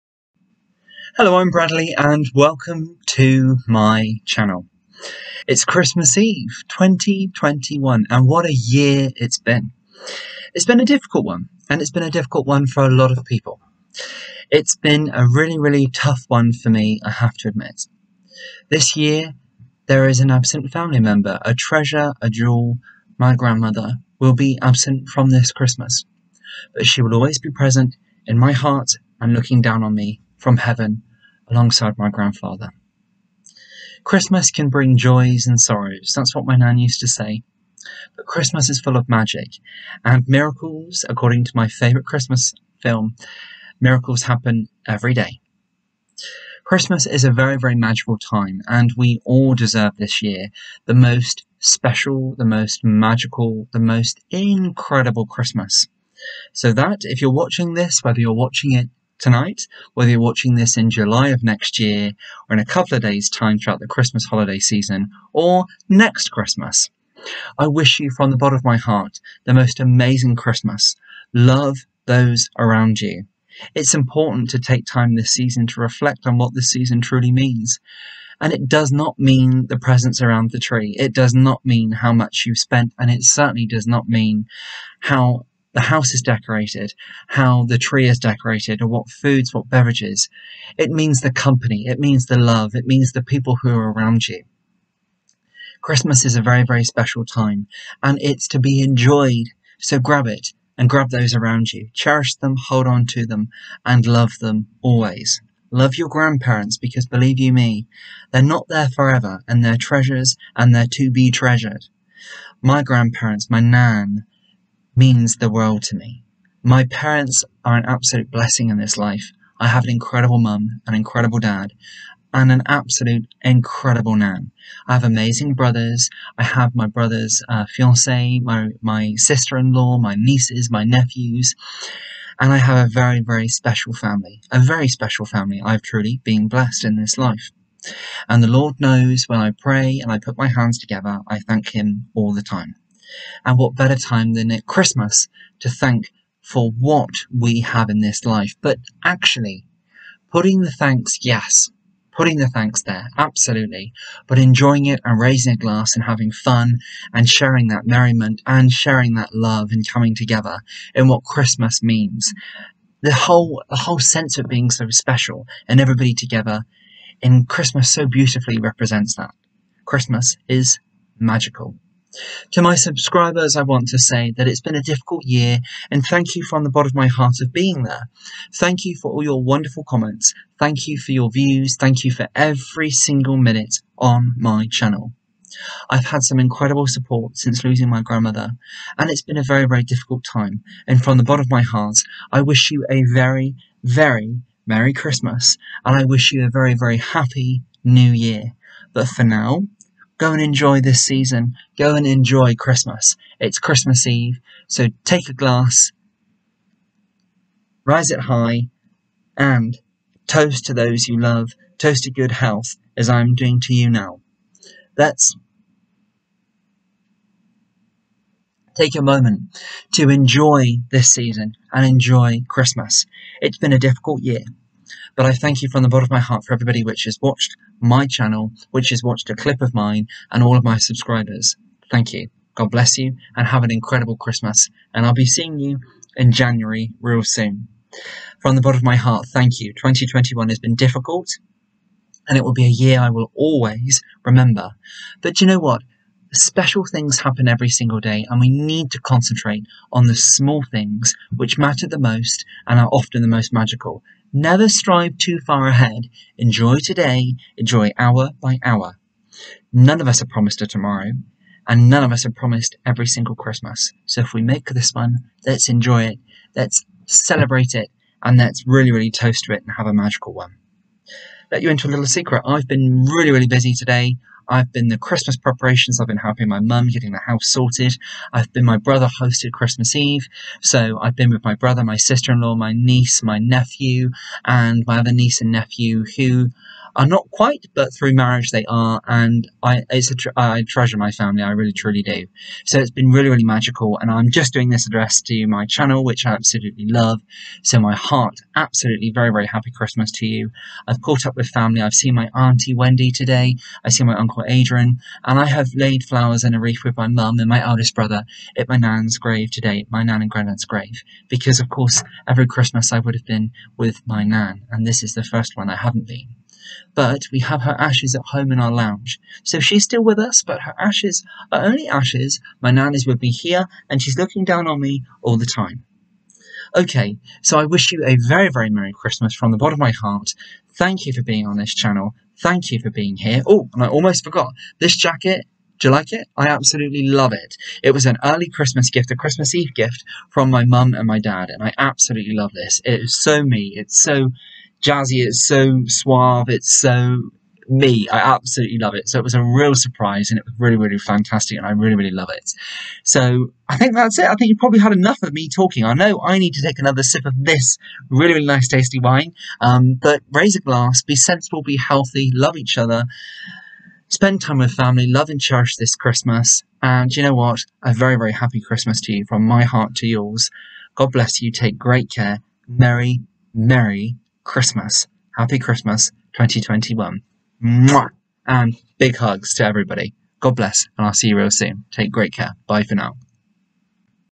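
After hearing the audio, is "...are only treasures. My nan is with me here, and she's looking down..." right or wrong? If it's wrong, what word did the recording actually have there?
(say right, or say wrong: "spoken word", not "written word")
wrong: "ashes", not "treasures".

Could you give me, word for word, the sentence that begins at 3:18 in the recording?
But for now, Go and enjoy this season.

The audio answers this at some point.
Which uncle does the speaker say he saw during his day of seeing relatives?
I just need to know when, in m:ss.
5:04.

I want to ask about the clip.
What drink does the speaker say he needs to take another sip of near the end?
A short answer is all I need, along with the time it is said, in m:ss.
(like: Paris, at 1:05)
Wine, at 5:58.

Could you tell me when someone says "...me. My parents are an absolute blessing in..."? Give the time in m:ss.
1:55.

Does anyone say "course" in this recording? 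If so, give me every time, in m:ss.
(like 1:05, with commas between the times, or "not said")
5:11.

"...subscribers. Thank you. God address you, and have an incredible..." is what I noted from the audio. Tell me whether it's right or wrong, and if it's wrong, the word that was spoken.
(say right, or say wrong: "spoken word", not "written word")
wrong: "bless", not "address".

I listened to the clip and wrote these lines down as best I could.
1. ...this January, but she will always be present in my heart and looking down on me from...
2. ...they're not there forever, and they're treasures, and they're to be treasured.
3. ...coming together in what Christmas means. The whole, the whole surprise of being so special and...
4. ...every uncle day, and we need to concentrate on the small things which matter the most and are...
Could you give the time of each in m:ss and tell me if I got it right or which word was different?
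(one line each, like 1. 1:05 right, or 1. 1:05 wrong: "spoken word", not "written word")
1. 0:25 wrong: "Christmas", not "January"
2. 1:48 right
3. 2:39 wrong: "sense", not "surprise"
4. 4:07 wrong: "single", not "uncle".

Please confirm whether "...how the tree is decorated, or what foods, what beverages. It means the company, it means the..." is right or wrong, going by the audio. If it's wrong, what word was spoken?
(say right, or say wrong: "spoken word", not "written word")
right.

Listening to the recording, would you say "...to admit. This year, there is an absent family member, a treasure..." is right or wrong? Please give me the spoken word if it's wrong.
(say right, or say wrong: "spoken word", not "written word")
right.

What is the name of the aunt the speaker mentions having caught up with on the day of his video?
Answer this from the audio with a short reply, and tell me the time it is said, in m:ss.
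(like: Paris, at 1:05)
Wendy, at 5:02.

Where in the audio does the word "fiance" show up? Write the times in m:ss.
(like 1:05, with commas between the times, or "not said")
2:07.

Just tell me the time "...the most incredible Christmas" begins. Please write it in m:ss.
0:53.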